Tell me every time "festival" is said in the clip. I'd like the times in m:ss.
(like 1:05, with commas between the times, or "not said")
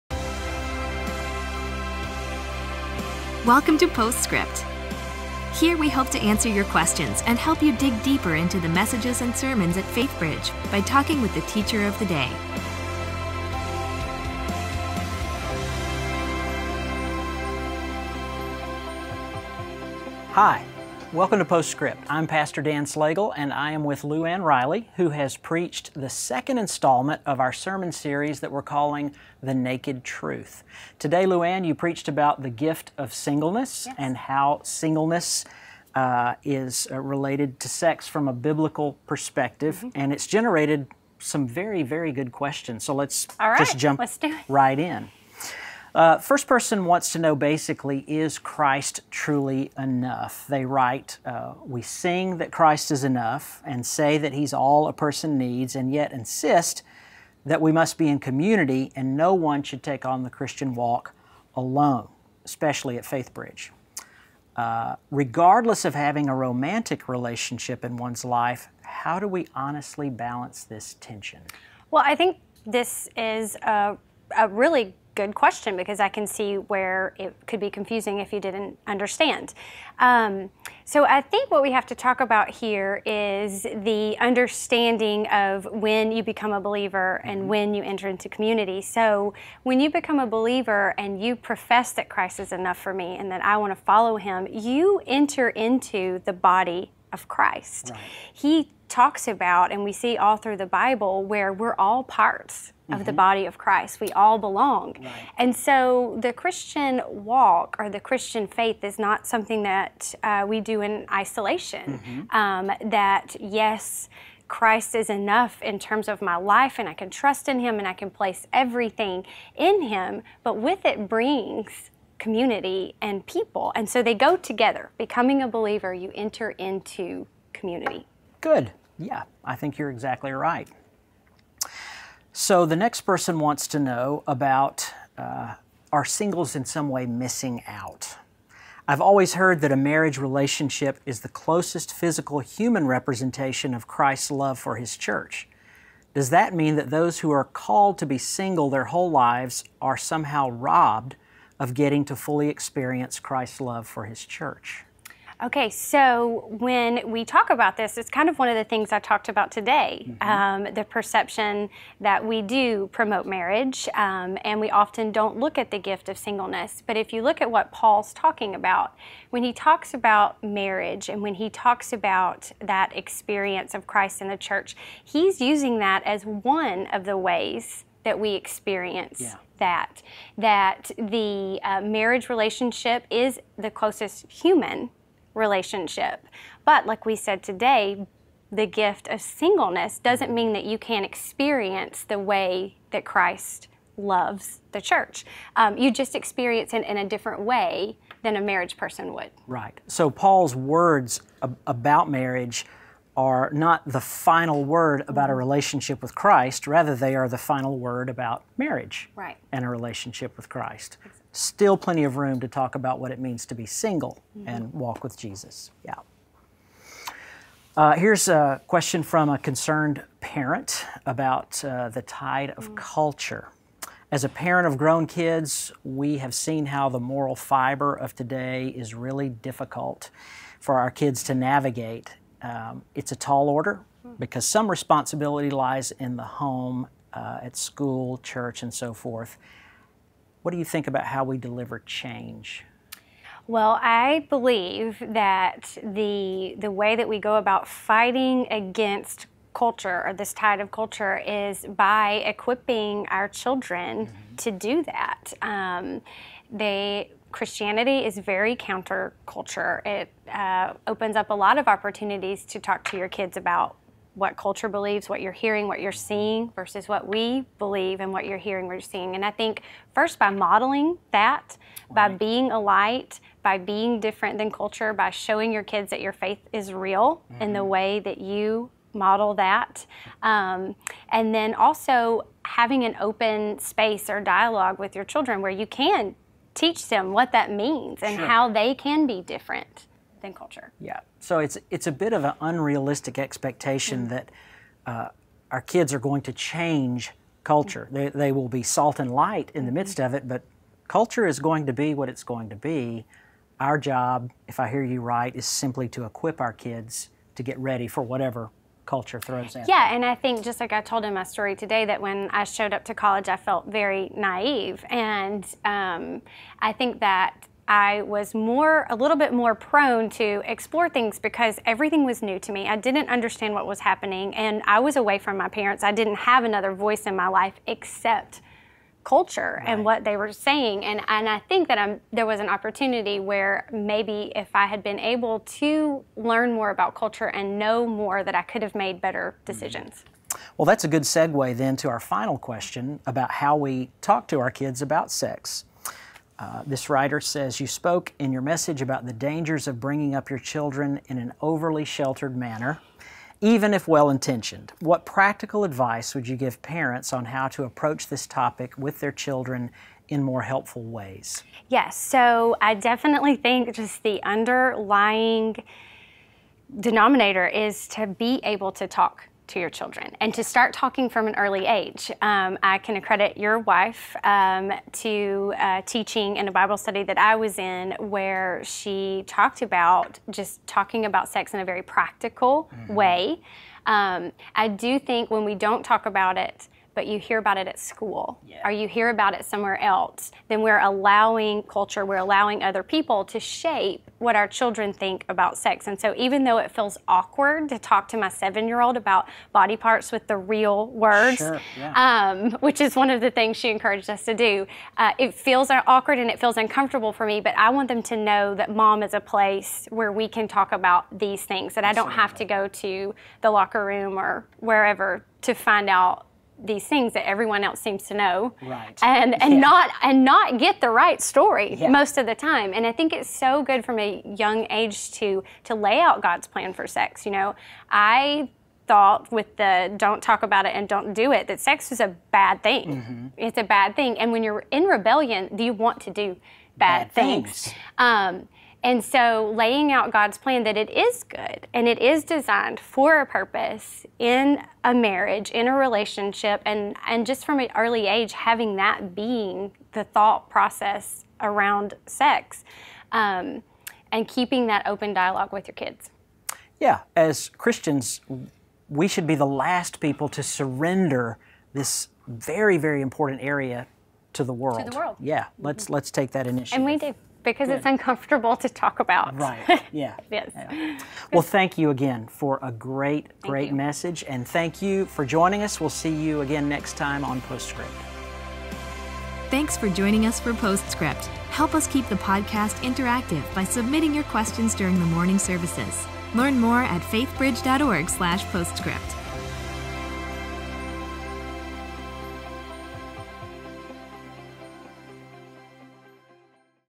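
not said.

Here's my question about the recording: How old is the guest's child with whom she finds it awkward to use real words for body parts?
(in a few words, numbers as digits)
7.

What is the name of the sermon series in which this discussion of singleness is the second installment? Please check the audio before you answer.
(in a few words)
The Naked Truth.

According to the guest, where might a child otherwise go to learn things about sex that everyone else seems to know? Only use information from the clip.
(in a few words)
the locker room.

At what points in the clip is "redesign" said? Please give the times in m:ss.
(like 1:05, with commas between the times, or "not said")
not said.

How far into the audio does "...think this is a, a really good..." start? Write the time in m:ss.
1:12.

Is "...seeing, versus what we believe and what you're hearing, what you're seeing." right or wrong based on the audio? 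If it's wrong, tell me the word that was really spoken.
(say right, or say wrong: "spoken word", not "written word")
right.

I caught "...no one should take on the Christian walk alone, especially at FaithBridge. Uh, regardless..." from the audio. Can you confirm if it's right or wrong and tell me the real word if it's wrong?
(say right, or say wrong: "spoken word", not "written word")
right.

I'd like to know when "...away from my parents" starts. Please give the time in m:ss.
5:24.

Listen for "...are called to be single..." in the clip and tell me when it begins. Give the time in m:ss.
2:27.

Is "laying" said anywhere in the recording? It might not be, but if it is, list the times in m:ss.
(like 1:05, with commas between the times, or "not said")
7:19.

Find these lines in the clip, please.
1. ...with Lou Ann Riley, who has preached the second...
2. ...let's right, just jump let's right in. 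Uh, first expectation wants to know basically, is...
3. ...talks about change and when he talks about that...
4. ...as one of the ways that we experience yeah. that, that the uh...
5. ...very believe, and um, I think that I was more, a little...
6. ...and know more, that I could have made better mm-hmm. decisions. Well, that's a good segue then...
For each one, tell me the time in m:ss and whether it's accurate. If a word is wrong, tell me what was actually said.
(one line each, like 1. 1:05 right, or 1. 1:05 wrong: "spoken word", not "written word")
1. 0:23 right
2. 0:42 wrong: "person", not "expectation"
3. 2:49 wrong: "marriage", not "change"
4. 2:56 right
5. 5:13 wrong: "naive", not "believe"
6. 5:37 right.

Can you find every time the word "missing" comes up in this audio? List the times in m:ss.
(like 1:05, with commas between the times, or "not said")
2:17.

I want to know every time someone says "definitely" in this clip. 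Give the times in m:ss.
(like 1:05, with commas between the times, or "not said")
6:02.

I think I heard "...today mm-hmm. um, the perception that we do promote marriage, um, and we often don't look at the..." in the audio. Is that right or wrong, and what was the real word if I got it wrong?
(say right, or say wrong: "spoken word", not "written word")
right.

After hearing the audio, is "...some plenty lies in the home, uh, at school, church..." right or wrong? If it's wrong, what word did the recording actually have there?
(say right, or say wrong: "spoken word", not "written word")
wrong: "responsibility", not "plenty".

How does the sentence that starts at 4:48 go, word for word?
how they can be different than culture.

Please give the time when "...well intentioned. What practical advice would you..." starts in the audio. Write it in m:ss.
5:53.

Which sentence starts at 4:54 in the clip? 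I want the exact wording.
that uh, our kids are going to change culture.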